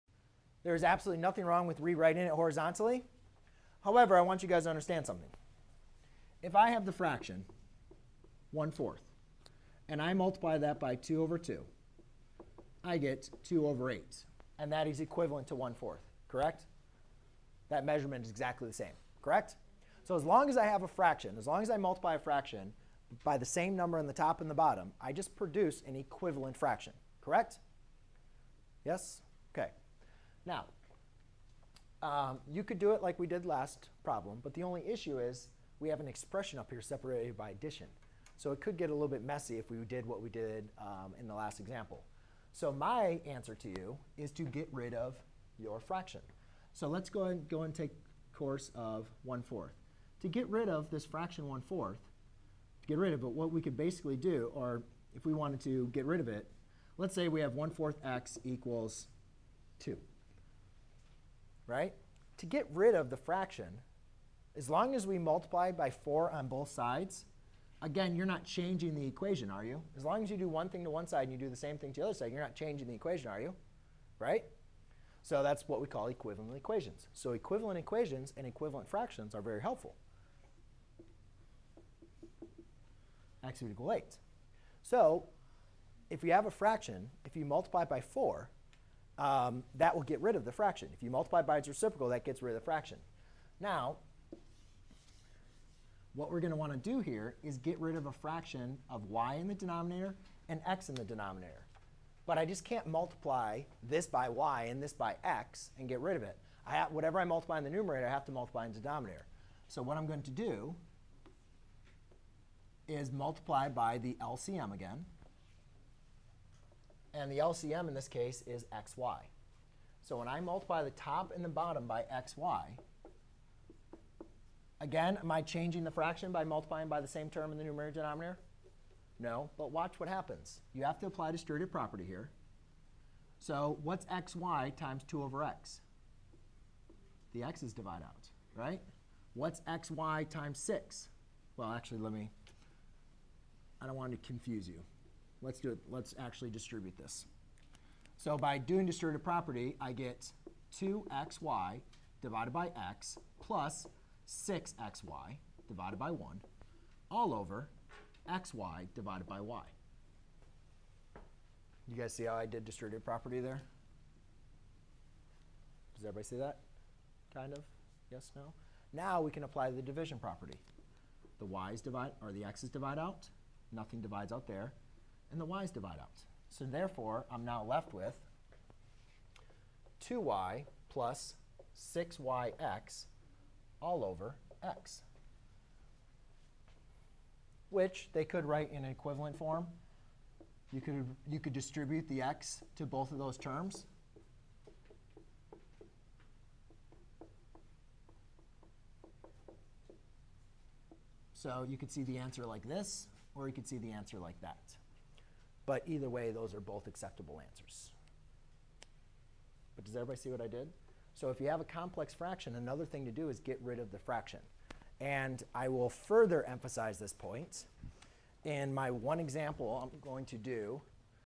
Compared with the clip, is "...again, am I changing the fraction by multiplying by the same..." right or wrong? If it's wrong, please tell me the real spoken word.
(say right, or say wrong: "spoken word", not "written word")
right.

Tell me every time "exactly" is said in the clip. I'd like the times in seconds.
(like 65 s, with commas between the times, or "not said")
18 s.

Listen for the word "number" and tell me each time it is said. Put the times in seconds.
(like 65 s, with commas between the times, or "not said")
23 s.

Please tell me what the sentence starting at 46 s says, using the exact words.
So let's go and go and take course of 1 fourth.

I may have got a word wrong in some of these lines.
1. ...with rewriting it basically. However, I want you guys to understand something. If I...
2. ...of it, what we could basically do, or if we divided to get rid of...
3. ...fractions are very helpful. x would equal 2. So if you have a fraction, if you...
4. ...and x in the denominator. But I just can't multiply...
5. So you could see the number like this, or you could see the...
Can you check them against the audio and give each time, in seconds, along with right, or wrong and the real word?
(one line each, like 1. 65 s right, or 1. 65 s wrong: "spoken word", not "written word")
1. 1 s wrong: "horizontally", not "basically"
2. 53 s wrong: "wanted", not "divided"
3. 78 s wrong: "8", not "2"
4. 100 s right
5. 201 s wrong: "answer", not "number".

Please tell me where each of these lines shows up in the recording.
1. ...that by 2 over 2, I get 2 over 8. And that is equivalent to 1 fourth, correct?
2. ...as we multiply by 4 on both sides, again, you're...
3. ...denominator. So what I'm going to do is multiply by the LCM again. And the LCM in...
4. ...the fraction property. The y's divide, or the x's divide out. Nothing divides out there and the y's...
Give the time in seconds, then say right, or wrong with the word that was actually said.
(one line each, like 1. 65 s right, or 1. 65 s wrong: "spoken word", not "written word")
1. 10 s right
2. 64 s right
3. 108 s right
4. 169 s wrong: "division", not "fraction".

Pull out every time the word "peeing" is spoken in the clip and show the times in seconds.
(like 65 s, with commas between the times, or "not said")
not said.